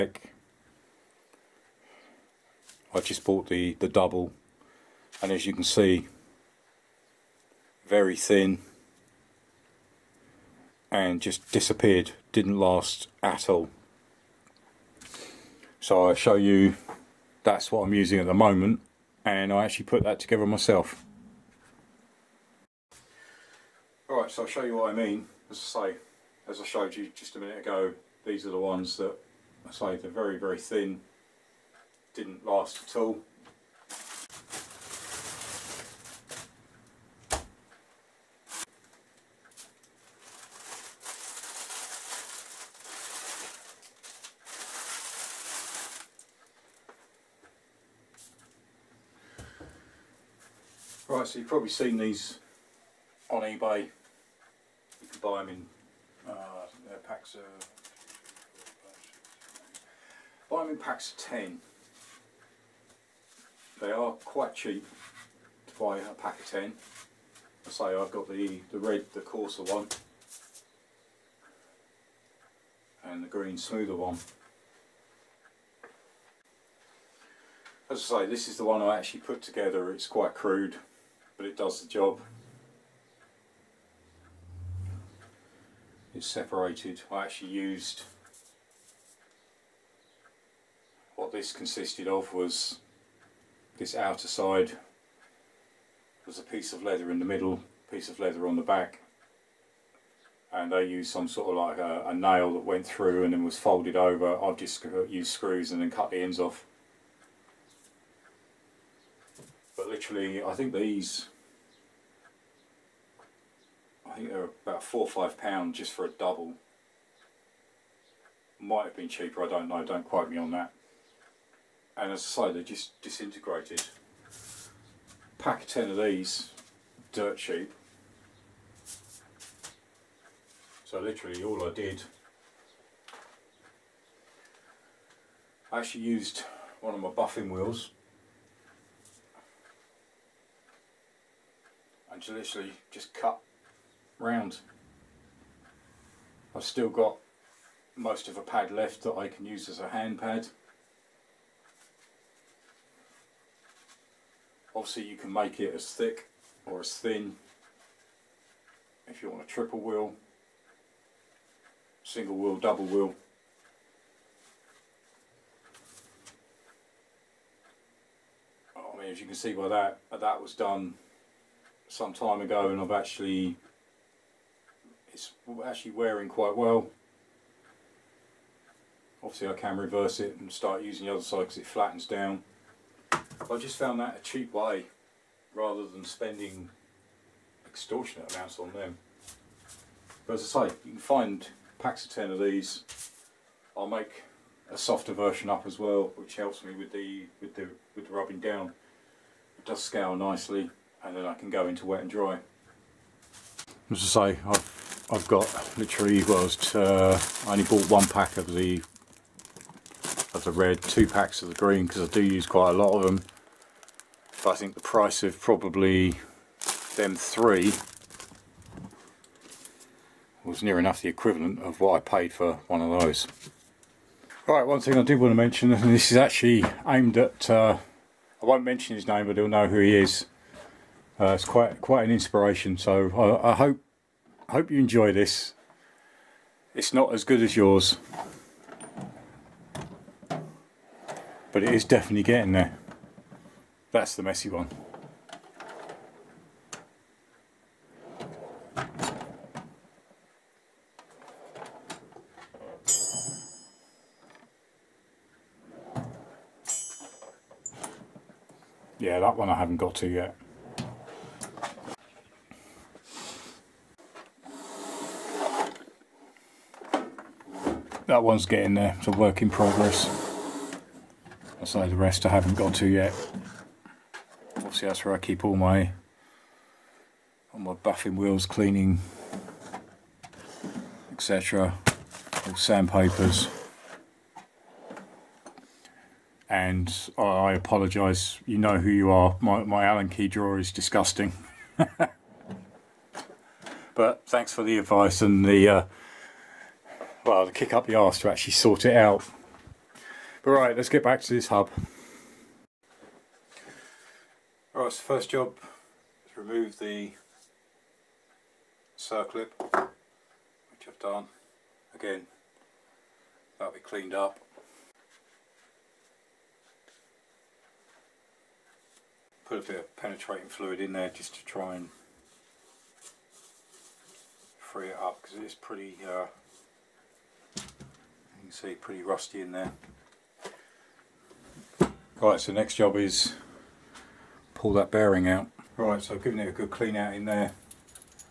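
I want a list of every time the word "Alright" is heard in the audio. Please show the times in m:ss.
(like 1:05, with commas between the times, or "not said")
0:24, 5:04.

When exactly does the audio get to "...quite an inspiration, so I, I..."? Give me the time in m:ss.
3:51.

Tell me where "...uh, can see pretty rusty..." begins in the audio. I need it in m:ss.
5:26.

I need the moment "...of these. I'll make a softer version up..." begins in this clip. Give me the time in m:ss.
3:12.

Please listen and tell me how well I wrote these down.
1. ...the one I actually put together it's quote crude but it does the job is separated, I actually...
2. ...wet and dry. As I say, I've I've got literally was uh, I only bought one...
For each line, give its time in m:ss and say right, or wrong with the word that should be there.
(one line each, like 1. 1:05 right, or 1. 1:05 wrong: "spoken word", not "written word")
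1. 1:18 wrong: "quite", not "quote"
2. 3:21 right.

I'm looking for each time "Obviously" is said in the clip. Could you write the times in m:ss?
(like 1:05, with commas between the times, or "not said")
2:34, 2:59, 4:34.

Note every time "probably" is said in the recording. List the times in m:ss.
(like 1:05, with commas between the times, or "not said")
0:51, 3:35.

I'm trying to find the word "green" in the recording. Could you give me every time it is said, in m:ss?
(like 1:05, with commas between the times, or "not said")
1:13, 3:31.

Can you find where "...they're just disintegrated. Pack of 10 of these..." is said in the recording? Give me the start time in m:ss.
2:02.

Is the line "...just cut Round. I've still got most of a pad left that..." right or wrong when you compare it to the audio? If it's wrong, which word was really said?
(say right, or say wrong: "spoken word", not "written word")
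right.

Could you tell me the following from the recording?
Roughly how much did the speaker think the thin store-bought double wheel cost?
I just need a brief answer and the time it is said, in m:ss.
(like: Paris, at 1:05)
4 or 5 pounds, at 1:54.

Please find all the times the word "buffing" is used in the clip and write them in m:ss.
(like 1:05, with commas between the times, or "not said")
2:17, 4:37.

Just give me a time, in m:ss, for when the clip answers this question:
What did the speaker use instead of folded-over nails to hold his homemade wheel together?
1:45.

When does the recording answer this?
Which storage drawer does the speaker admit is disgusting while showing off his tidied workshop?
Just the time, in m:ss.
4:49.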